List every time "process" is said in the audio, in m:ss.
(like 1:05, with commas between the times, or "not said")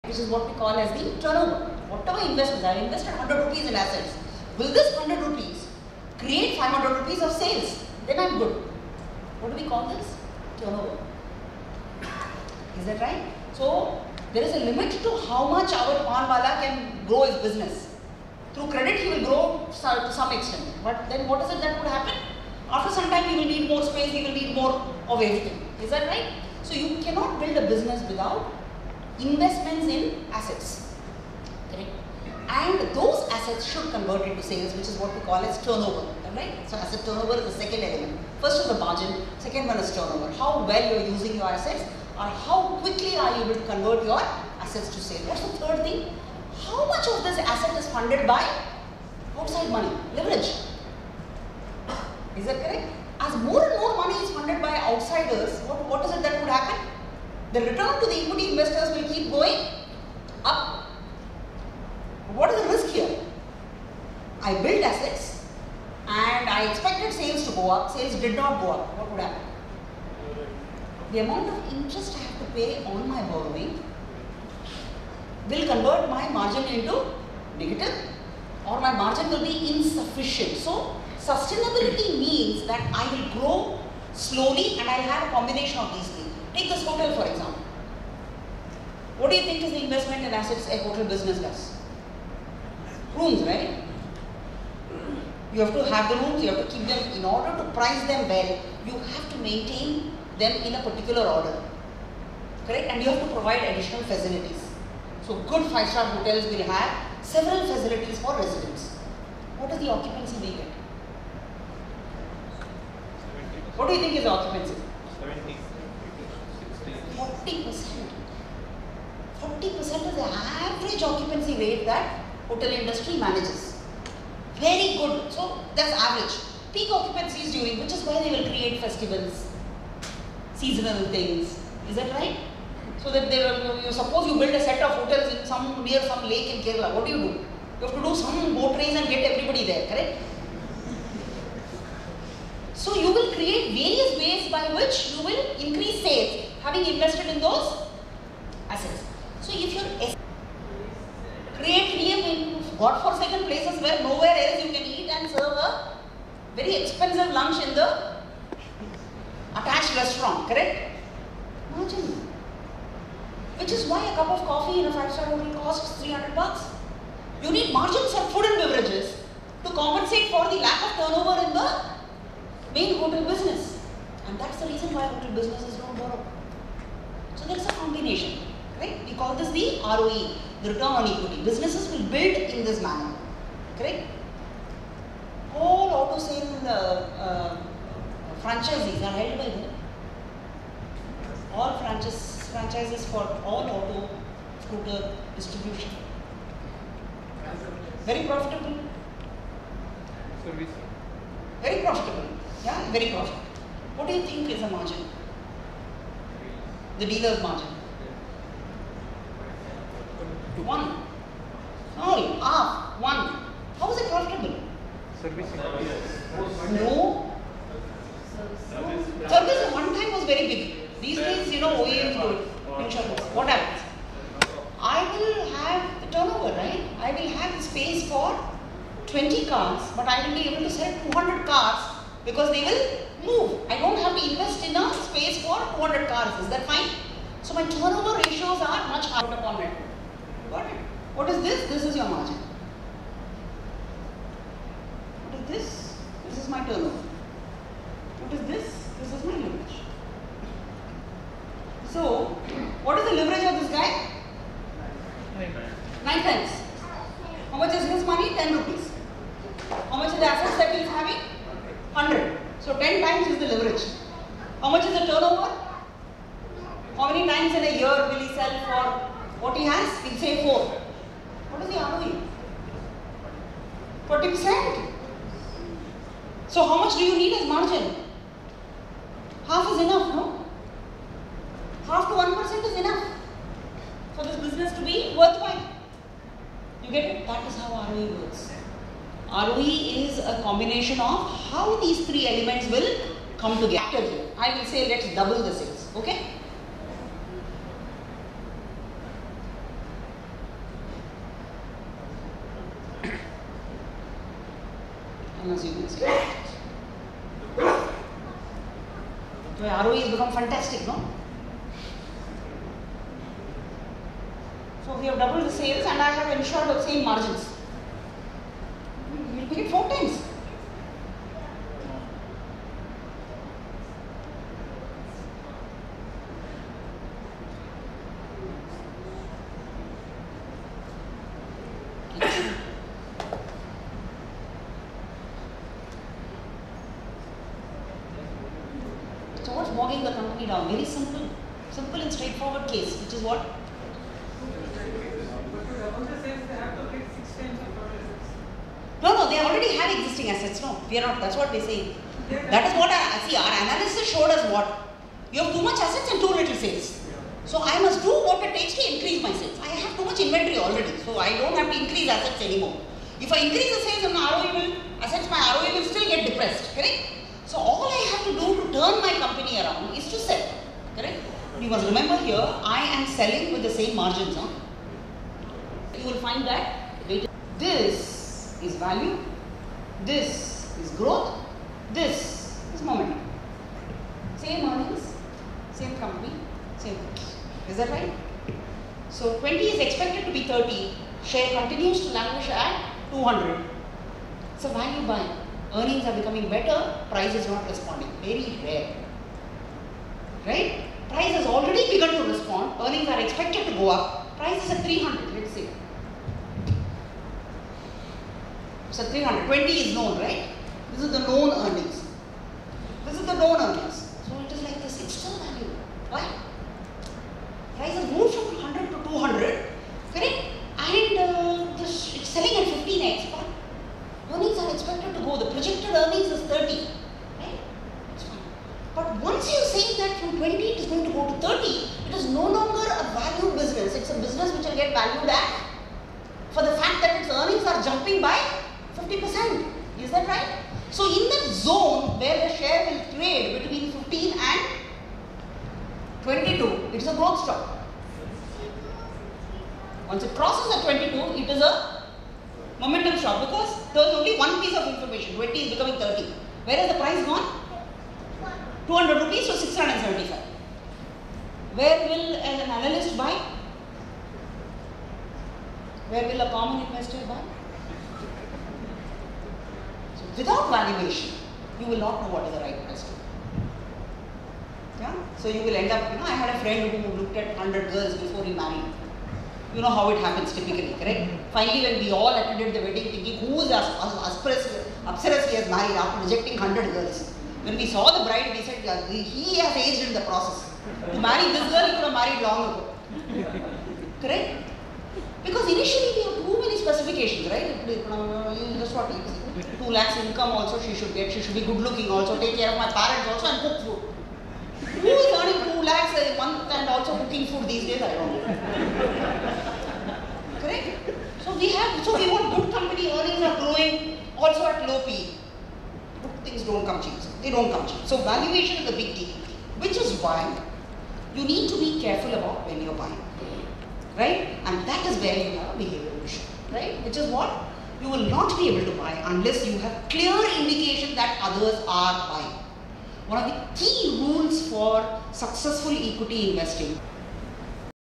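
8:10.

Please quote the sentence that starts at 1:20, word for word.
So sustainability means that I will grow slowly and I'll have a combination of these things.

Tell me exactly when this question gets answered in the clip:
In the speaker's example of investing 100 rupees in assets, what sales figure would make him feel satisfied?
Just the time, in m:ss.
0:06.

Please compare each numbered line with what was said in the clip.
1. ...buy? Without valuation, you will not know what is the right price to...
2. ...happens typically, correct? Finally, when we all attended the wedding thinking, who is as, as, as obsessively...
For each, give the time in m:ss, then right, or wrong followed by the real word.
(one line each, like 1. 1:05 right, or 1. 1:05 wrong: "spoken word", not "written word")
1. 7:47 right
2. 8:00 right.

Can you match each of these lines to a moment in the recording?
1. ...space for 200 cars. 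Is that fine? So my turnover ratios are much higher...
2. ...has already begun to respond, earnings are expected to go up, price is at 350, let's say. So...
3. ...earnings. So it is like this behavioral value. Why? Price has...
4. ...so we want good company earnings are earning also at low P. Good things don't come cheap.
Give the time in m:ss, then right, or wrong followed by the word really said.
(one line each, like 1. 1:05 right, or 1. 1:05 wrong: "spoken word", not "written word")
1. 3:54 right
2. 6:41 wrong: "300", not "350"
3. 6:53 wrong: "external", not "behavioral"
4. 8:32 wrong: "growing", not "earning".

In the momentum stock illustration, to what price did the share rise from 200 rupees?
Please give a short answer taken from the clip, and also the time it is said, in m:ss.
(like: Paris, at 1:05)
675, at 7:39.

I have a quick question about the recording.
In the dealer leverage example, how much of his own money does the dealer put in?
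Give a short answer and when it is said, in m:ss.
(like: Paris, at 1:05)
10 rupees, at 4:18.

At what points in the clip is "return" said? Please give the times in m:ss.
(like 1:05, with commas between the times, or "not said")
0:57, 3:00.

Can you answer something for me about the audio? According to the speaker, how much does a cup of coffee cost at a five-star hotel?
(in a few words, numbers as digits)
300 bucks.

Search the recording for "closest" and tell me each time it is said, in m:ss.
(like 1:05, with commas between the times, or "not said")
not said.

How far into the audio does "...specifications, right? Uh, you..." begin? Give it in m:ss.
8:16.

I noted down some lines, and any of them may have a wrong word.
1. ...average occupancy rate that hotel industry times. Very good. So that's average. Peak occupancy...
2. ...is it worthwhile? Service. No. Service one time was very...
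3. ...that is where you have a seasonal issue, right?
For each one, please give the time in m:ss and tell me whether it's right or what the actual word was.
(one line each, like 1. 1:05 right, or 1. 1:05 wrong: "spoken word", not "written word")
1. 2:00 wrong: "manages", not "times"
2. 3:33 wrong: "profitable", not "worthwhile"
3. 8:44 wrong: "behavioral", not "seasonal".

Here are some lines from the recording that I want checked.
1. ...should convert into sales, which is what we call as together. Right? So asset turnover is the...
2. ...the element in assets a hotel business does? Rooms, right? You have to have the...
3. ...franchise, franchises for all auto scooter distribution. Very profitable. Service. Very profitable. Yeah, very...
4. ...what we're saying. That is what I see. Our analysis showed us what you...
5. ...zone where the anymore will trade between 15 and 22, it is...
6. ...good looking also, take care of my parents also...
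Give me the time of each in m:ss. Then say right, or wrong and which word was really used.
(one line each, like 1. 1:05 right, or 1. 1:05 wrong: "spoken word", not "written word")
1. 0:33 wrong: "turnover", not "together"
2. 1:29 wrong: "investment", not "element"
3. 3:11 right
4. 5:51 right
5. 7:21 wrong: "share", not "anymore"
6. 8:21 right.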